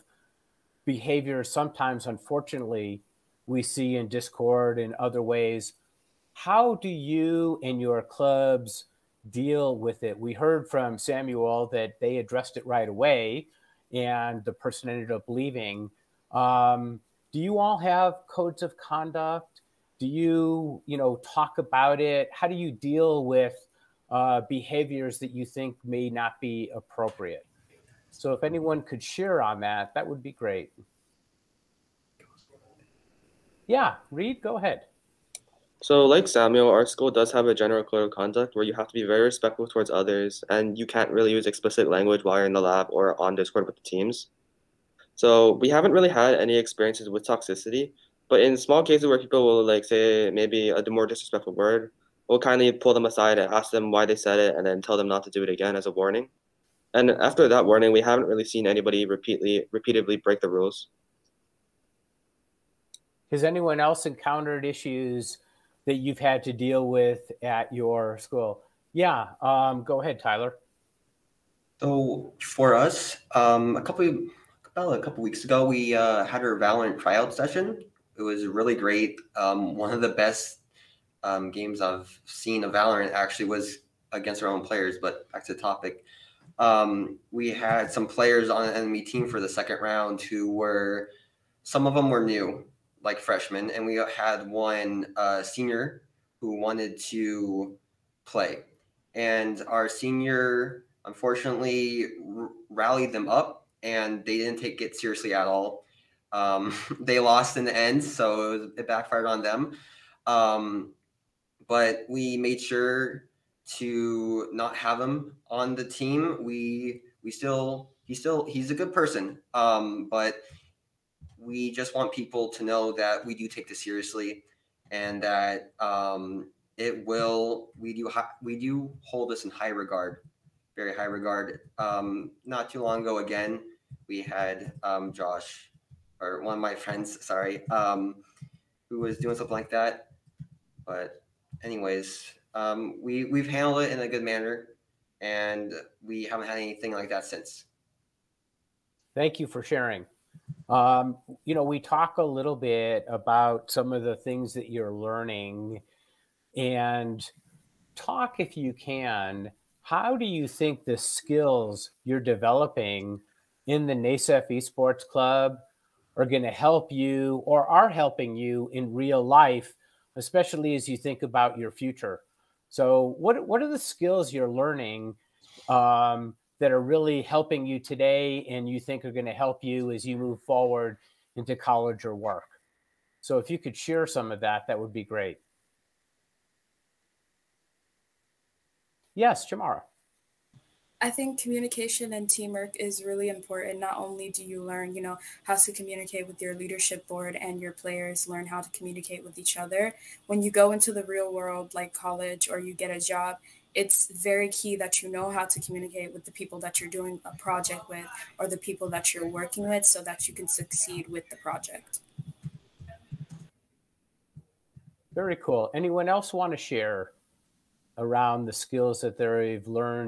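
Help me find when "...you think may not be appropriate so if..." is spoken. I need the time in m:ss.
0:25.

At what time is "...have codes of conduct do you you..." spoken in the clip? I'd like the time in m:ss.
0:17.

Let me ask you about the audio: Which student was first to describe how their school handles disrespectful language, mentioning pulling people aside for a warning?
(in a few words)
Reed.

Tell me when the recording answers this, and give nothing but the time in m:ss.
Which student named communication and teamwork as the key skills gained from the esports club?
3:09.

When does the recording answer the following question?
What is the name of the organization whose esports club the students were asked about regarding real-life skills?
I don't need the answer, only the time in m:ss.
2:43.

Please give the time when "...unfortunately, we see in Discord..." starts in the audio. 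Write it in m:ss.
0:02.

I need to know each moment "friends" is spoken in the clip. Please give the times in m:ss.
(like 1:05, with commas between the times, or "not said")
2:16.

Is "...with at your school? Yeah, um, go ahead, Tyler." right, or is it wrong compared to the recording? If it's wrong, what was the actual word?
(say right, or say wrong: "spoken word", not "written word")
right.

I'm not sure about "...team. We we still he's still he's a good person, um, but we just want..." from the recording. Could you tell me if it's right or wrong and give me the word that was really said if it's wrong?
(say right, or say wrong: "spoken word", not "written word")
right.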